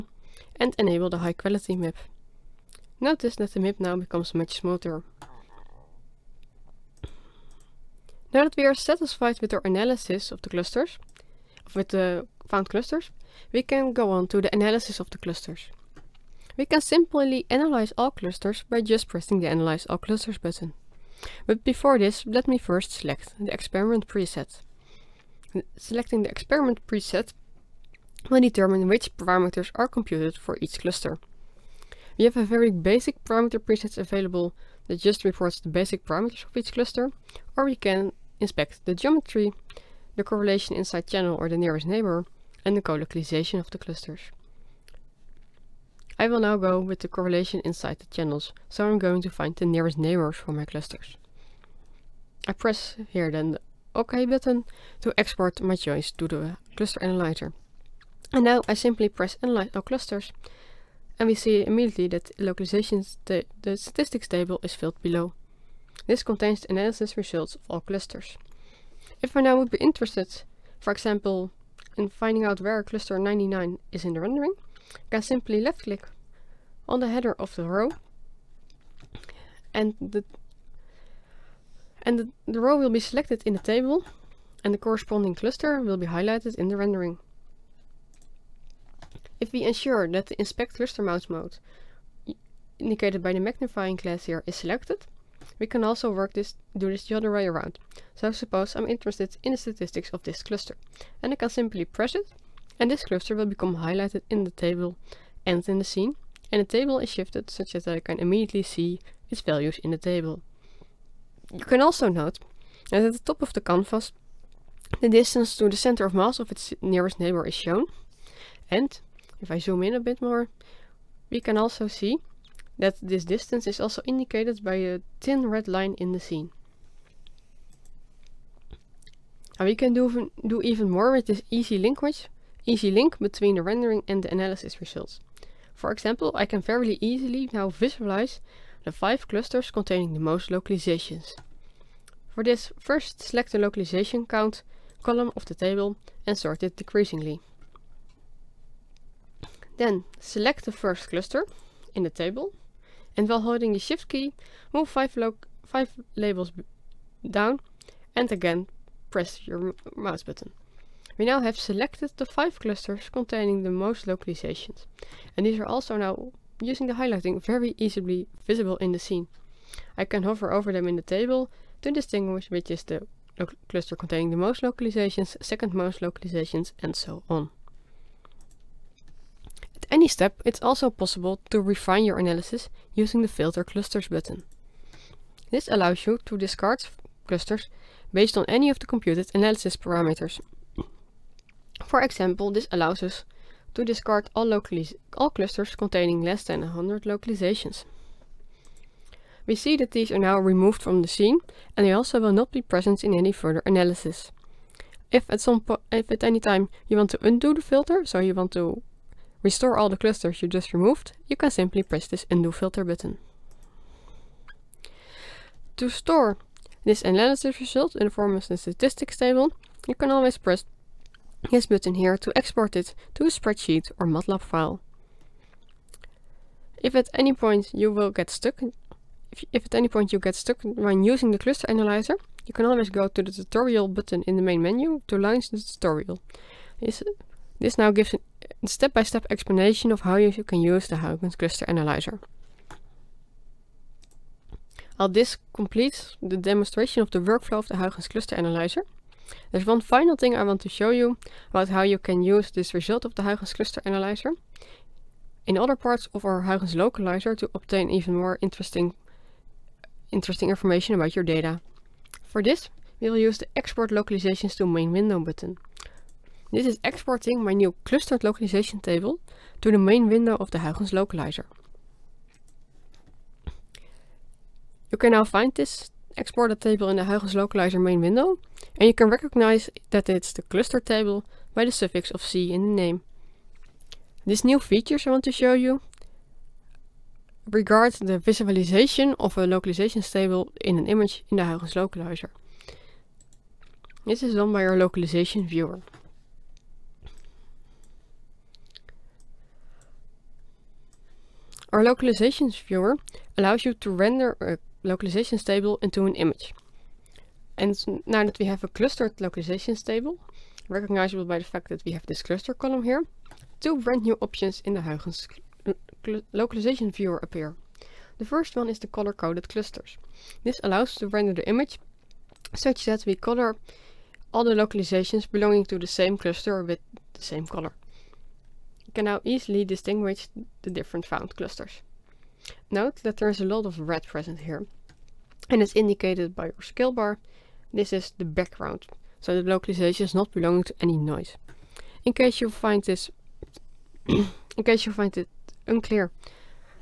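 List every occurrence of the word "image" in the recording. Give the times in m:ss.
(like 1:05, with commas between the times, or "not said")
4:50, 5:06, 5:21.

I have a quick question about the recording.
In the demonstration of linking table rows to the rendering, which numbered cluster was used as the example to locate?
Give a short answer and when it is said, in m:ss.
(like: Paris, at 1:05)
99, at 1:12.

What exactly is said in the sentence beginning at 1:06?
This contains analysis results of all clusters.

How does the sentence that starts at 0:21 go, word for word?
But before this, let me first select the experiment preset.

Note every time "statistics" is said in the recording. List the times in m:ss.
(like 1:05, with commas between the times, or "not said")
1:03, 1:39, 3:38.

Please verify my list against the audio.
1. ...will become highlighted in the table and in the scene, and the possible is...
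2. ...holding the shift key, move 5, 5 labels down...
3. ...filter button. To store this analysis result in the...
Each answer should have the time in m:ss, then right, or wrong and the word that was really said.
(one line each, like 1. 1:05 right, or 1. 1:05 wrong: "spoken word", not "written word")
1. 1:43 wrong: "table", not "possible"
2. 2:33 right
3. 3:32 right.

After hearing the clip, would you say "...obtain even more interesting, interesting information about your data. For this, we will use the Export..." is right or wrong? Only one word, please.
right.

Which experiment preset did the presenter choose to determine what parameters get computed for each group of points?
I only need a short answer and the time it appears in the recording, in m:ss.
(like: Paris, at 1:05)
Correlation inside channel, at 0:47.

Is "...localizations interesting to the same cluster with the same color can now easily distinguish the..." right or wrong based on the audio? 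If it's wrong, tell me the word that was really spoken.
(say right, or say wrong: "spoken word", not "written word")
wrong: "belonging", not "interesting".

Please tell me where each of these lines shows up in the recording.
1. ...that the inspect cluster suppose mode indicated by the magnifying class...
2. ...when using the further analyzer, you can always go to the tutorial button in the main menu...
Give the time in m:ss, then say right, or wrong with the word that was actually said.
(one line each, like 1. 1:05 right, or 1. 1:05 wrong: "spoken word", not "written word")
1. 1:30 wrong: "mouse", not "suppose"
2. 3:50 wrong: "cluster", not "further".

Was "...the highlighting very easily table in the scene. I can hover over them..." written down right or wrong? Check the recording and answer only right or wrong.
wrong.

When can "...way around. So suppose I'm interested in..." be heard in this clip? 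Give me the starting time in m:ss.
1:37.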